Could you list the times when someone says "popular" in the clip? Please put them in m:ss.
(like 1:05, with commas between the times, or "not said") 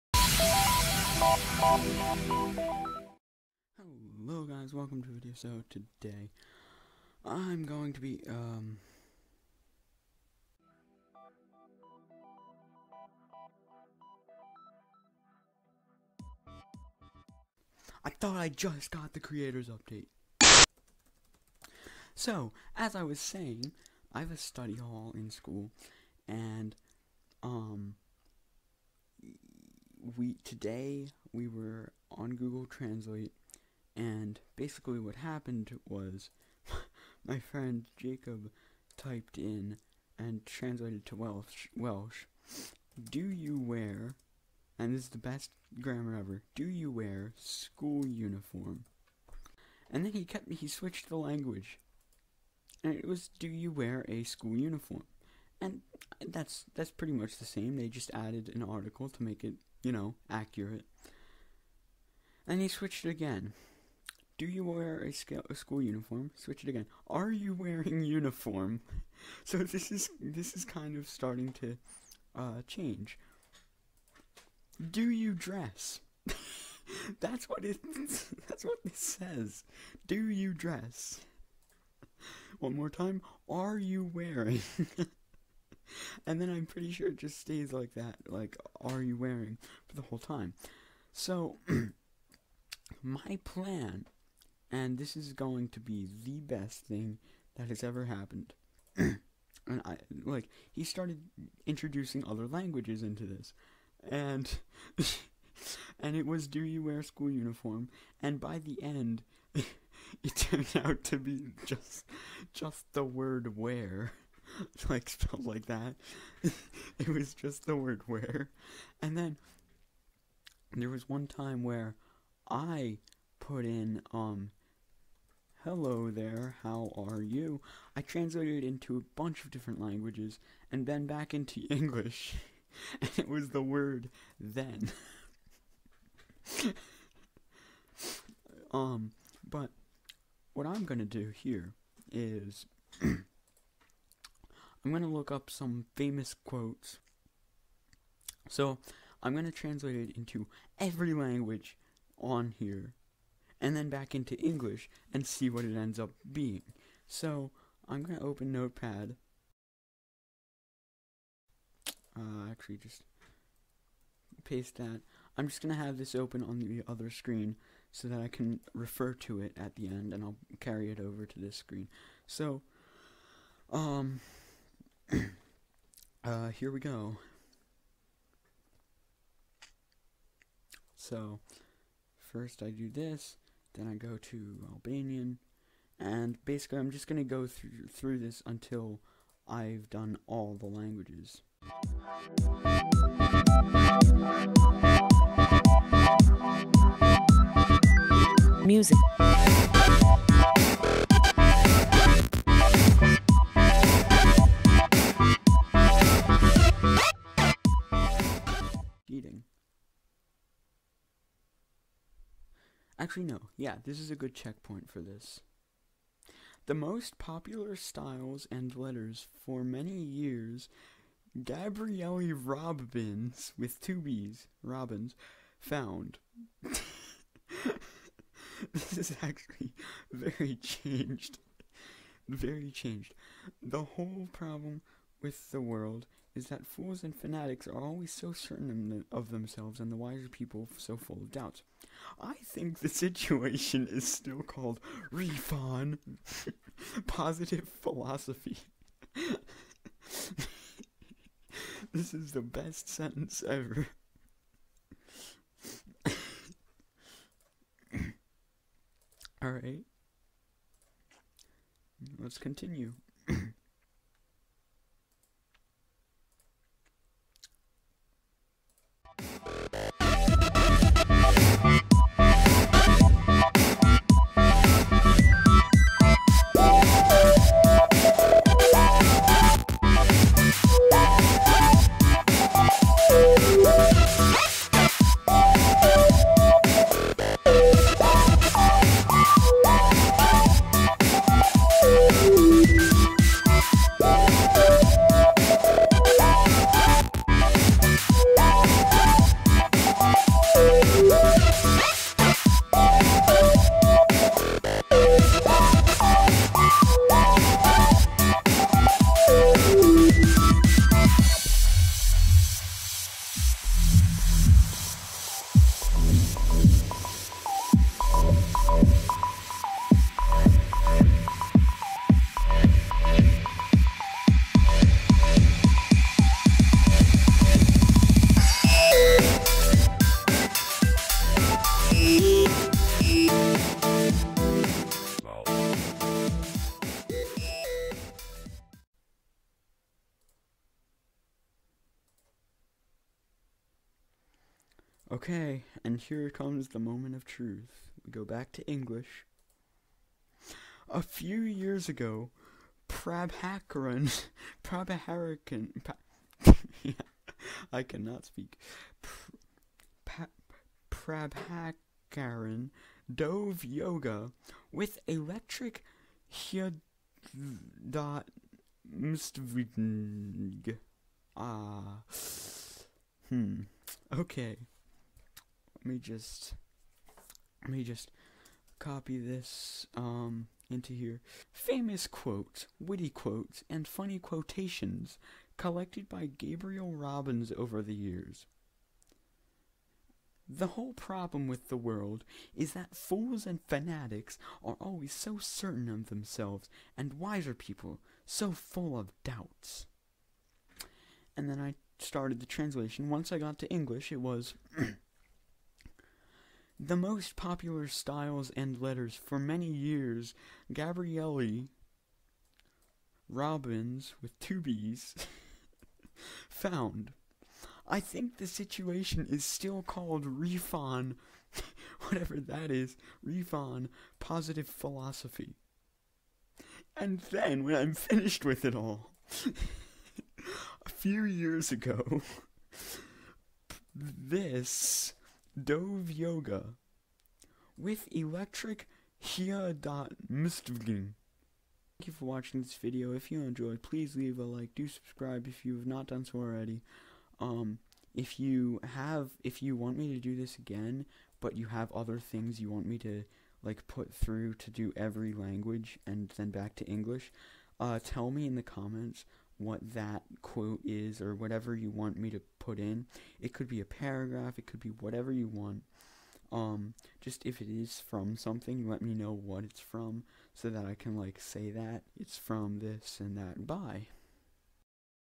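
3:37, 6:47.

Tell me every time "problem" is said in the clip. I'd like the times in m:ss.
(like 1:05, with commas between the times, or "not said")
3:54, 6:30.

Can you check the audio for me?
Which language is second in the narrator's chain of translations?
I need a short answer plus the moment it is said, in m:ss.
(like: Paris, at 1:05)
Albanian, at 3:04.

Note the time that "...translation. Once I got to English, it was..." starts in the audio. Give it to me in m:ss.
6:42.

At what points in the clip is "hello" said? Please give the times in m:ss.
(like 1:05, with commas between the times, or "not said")
0:03, 2:05.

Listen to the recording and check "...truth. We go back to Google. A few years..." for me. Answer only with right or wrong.
wrong.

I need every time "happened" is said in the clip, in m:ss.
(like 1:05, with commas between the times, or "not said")
0:35, 1:38.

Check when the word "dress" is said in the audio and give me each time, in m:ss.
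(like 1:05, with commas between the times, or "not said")
1:15, 1:20.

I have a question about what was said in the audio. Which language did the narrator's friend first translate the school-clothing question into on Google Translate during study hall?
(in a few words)
Welsh.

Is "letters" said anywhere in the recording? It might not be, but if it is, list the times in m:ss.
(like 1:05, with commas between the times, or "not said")
3:38, 6:48.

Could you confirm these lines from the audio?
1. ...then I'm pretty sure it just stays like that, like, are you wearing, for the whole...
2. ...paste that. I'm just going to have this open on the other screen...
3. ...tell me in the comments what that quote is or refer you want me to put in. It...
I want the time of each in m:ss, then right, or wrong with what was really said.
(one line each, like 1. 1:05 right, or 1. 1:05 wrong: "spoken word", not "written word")
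1. 1:26 right
2. 2:44 right
3. 7:38 wrong: "whatever", not "refer".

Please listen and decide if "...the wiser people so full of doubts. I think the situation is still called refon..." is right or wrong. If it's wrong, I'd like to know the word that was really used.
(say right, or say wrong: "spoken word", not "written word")
right.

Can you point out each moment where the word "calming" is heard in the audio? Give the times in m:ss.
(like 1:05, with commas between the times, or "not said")
not said.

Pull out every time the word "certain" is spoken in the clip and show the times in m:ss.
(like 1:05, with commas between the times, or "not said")
3:58, 6:35.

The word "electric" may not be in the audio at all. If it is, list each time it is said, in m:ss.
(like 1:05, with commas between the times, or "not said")
6:05, 7:18.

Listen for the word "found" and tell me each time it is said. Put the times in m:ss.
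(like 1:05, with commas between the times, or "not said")
3:45, 6:56.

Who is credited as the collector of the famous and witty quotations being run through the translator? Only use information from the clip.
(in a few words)
Gabriel Robbins.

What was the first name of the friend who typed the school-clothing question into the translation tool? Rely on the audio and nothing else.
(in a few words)
Jacob.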